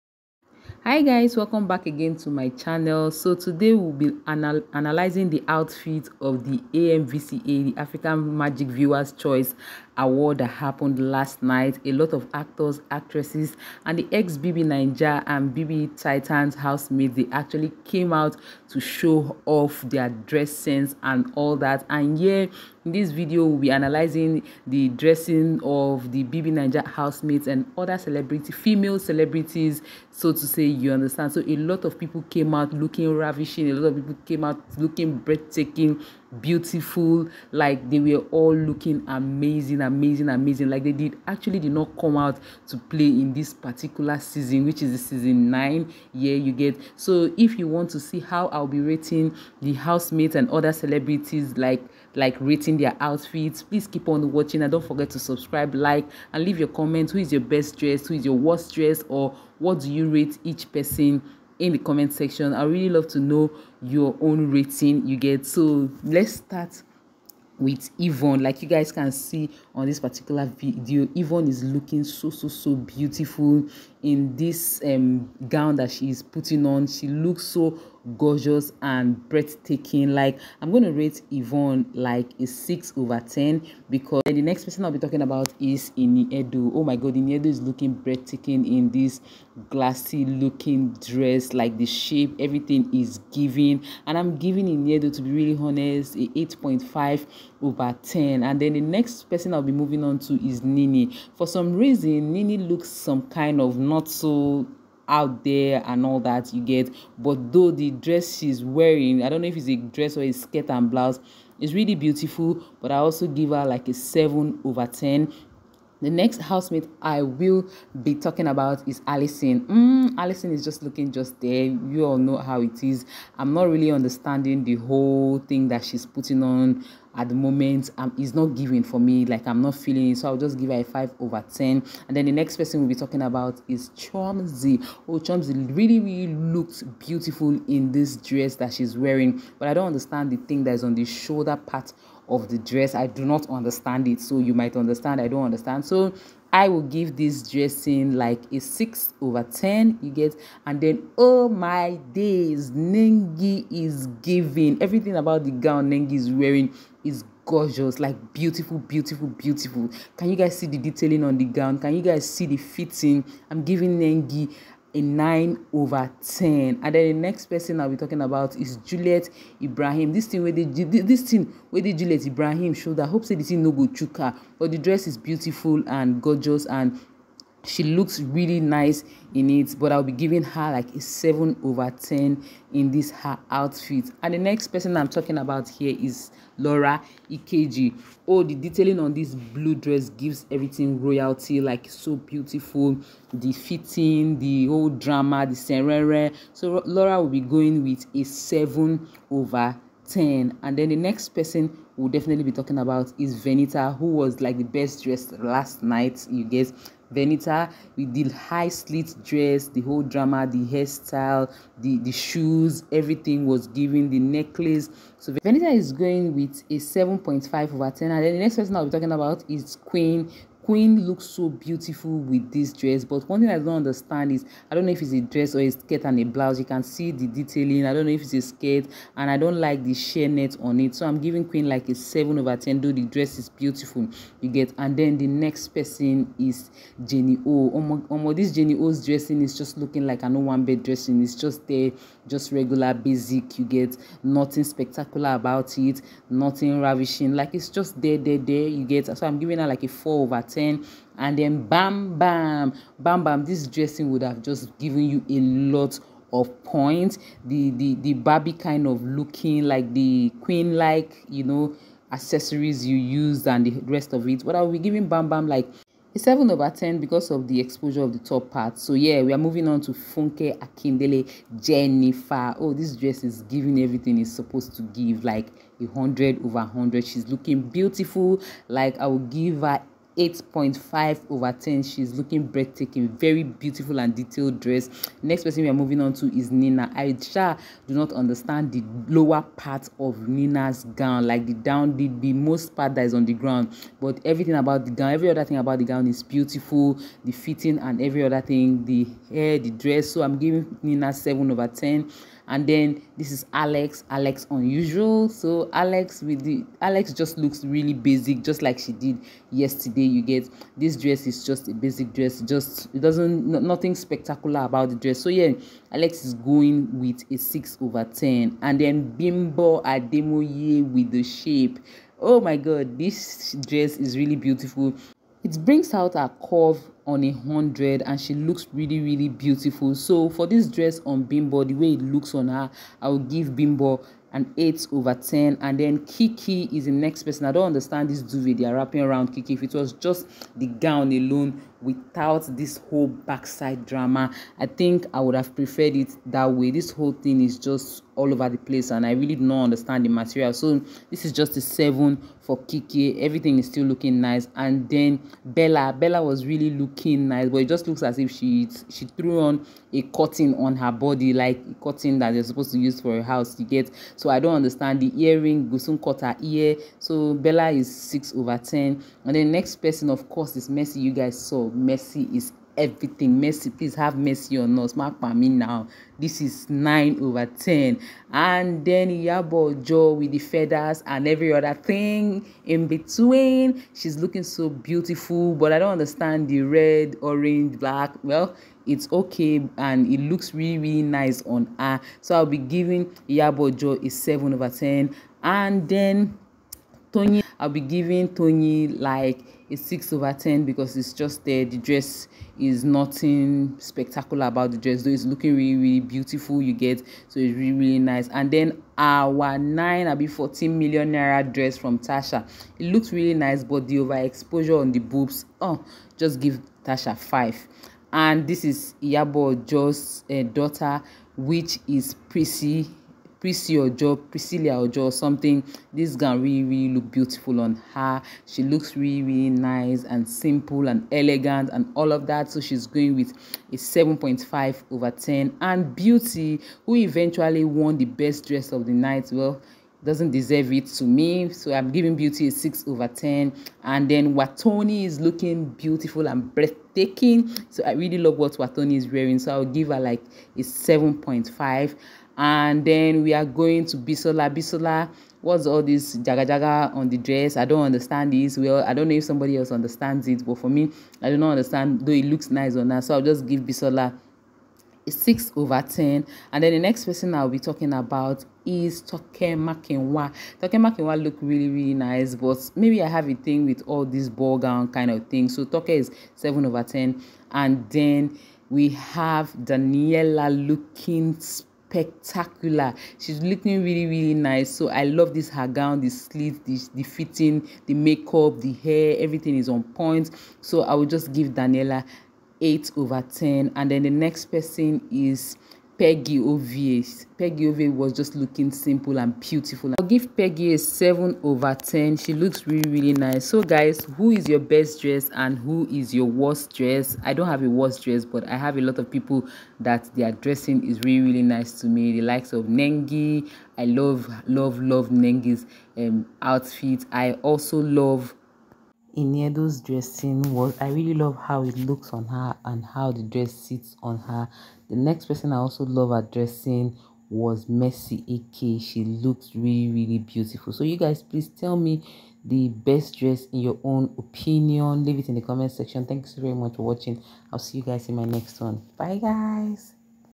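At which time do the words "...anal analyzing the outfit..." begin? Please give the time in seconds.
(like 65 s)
4 s.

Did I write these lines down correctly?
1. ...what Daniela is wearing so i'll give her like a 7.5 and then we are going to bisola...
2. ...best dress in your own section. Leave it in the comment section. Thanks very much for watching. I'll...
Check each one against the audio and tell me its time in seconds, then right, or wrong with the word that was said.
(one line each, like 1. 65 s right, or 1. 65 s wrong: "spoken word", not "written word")
1. 448 s wrong: "Wathoni", not "Daniela"
2. 532 s wrong: "opinion", not "section".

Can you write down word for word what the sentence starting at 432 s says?
So she's going with a 7.5 over 10.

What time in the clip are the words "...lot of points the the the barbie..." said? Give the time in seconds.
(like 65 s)
255 s.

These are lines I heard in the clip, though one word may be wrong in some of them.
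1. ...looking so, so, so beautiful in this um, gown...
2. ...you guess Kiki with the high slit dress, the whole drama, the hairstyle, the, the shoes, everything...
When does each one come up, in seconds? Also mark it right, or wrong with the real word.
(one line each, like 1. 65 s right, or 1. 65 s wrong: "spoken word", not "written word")
1. 71 s right
2. 206 s wrong: "Venita", not "Kiki".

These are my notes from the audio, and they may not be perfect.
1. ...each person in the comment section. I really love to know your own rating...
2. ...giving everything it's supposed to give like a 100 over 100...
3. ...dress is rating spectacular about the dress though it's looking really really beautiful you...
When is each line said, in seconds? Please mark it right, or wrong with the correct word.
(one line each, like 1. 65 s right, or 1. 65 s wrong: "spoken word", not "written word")
1. 60 s right
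2. 273 s right
3. 401 s wrong: "nothing", not "rating".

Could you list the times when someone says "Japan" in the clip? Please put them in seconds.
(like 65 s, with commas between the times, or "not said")
not said.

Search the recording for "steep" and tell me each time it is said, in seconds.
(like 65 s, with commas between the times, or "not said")
not said.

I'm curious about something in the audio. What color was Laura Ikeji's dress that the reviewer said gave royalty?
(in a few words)
Blue.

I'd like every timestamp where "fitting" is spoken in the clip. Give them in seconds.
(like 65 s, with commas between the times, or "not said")
162 s, 193 s, 297 s, 487 s.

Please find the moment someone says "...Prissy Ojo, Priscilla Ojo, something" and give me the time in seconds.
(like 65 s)
423 s.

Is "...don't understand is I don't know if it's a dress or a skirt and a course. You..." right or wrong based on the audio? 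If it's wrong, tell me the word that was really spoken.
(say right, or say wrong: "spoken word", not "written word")
wrong: "blouse", not "course".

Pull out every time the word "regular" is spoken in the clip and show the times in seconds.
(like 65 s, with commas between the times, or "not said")
242 s.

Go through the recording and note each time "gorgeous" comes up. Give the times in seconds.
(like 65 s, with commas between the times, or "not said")
78 s, 157 s, 176 s.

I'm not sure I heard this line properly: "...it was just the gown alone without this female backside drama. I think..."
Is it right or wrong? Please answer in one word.
wrong.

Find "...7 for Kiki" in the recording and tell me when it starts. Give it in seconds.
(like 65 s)
351 s.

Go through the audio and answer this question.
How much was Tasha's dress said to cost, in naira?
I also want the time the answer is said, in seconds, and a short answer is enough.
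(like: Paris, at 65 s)
14 million naira, at 410 s.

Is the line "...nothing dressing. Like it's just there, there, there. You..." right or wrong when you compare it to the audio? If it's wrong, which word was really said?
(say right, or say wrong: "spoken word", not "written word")
wrong: "ravishing", not "dressing".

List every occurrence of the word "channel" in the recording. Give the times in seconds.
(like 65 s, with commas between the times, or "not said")
2 s.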